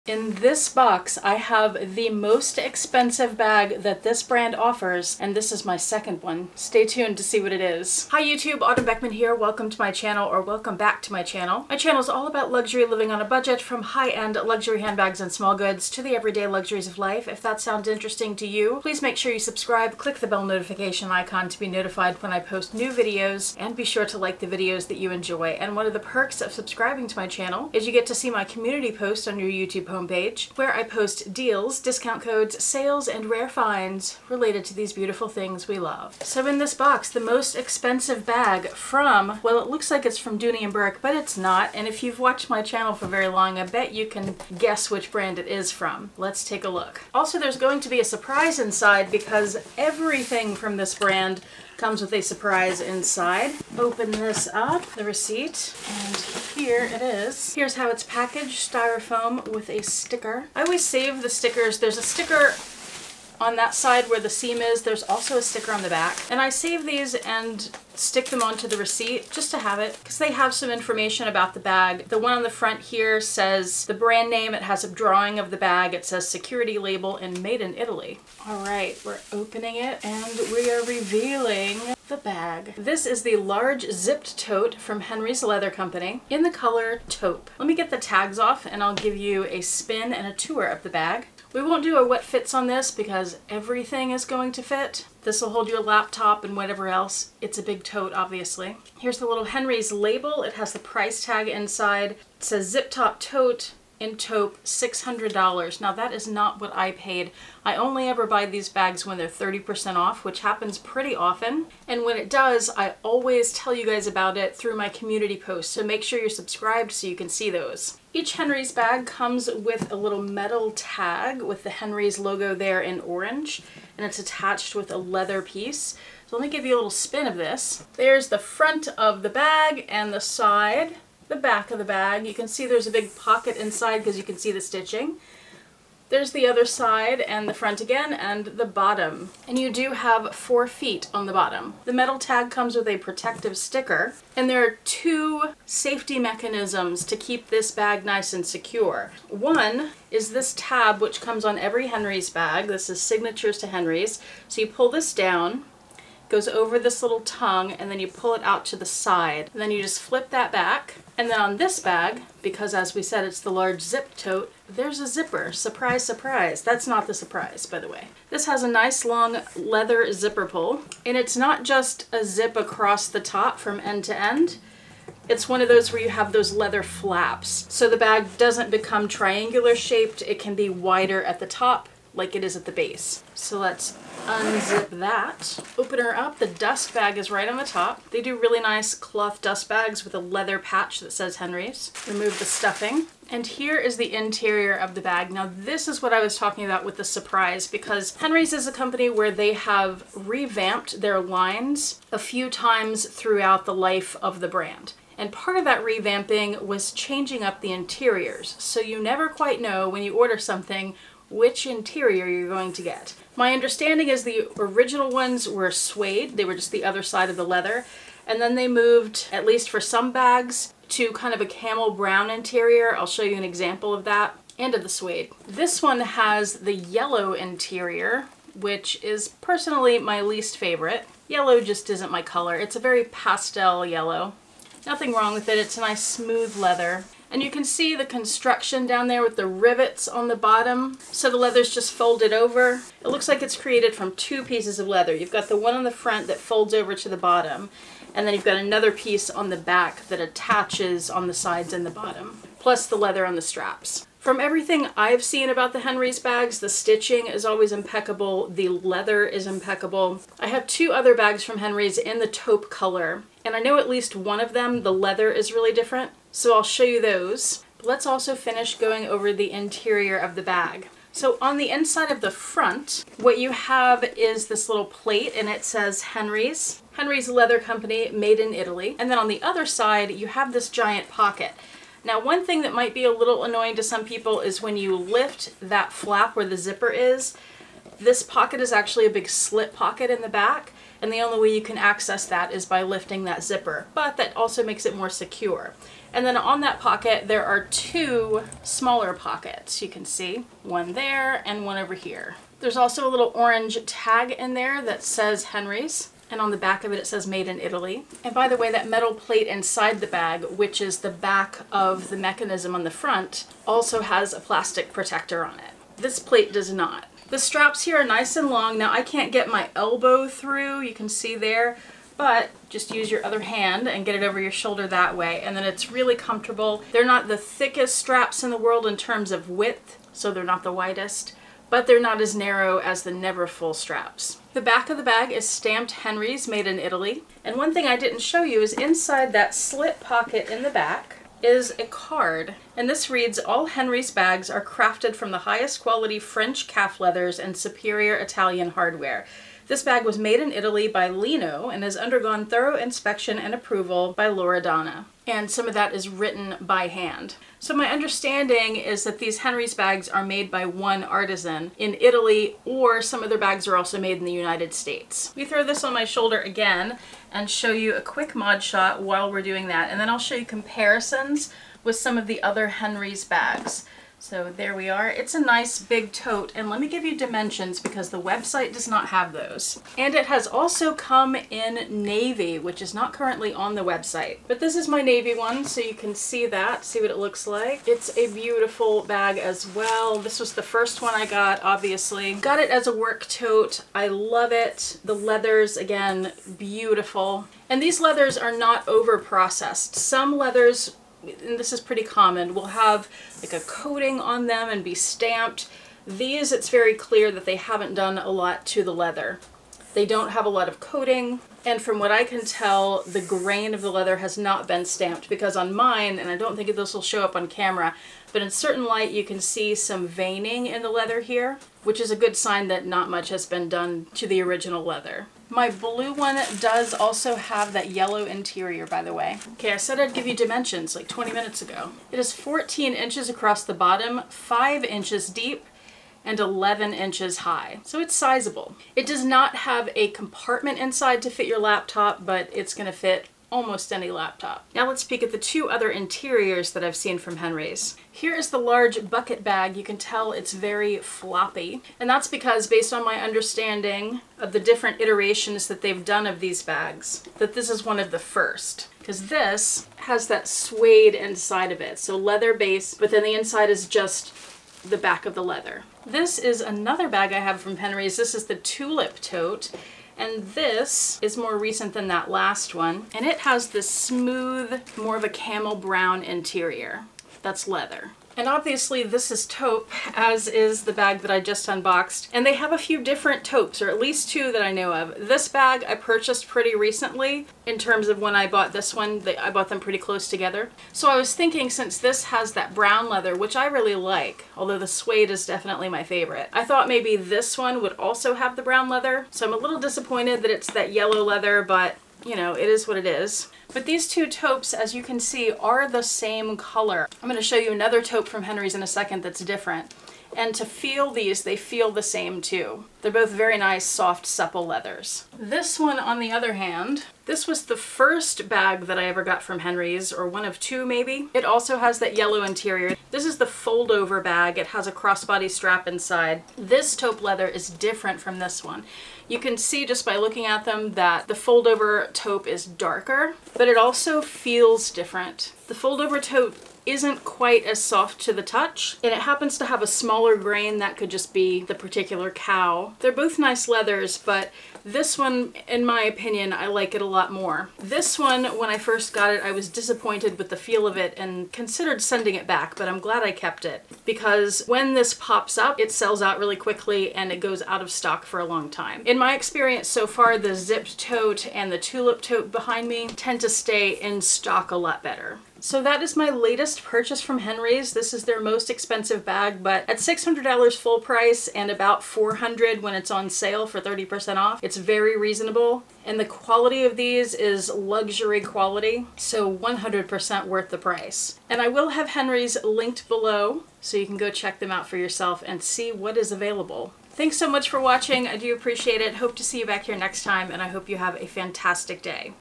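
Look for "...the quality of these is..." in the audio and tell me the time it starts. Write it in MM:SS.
09:36.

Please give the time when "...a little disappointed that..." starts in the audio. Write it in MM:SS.
08:19.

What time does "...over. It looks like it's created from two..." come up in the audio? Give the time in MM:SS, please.
04:02.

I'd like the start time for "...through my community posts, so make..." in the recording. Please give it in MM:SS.
01:54.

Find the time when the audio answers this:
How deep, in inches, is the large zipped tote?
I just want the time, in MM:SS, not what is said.
07:14.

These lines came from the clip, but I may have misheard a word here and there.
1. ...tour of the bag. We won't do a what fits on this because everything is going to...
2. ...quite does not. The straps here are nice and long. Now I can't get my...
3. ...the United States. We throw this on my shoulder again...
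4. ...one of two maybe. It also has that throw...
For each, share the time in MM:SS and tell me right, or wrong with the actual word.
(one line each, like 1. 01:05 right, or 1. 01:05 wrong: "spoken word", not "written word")
1. 01:30 right
2. 05:16 wrong: "plate", not "quite"
3. 06:04 right
4. 08:40 wrong: "yellow", not "throw".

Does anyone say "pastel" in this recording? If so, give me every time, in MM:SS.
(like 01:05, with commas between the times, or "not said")
03:53.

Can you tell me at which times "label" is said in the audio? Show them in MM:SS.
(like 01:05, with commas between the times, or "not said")
01:16, 01:39.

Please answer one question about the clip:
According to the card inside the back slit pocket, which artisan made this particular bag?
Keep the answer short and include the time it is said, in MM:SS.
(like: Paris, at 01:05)
Lino, at 05:51.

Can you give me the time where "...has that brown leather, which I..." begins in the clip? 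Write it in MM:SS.
08:12.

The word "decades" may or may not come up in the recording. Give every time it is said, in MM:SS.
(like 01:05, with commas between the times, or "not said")
not said.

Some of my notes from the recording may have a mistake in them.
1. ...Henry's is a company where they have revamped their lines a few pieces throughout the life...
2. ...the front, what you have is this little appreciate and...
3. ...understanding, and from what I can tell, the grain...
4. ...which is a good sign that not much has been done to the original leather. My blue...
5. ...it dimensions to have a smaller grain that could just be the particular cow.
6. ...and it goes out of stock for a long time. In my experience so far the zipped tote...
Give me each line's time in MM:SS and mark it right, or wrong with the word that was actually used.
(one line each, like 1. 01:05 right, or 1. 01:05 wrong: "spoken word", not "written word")
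1. 03:18 wrong: "times", not "pieces"
2. 04:32 wrong: "plate", not "appreciate"
3. 06:50 wrong: "coating", not "understanding"
4. 07:01 right
5. 08:59 wrong: "happens", not "dimensions"
6. 09:17 right.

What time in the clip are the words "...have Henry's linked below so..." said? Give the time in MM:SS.
09:41.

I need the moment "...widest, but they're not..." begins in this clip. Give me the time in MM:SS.
05:30.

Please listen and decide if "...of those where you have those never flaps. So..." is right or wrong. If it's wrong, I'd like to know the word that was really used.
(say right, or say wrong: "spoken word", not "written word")
wrong: "leather", not "never".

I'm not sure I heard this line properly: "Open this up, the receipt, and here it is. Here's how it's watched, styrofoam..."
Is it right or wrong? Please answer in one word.
wrong.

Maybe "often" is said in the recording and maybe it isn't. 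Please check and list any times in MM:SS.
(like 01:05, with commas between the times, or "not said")
01:51.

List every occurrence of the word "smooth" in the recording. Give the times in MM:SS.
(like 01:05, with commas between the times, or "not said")
03:56, 07:53.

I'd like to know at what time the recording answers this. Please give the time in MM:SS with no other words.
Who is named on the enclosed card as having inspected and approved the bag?
05:54.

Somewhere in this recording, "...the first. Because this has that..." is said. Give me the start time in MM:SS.
07:38.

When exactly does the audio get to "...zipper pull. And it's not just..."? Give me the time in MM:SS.
02:50.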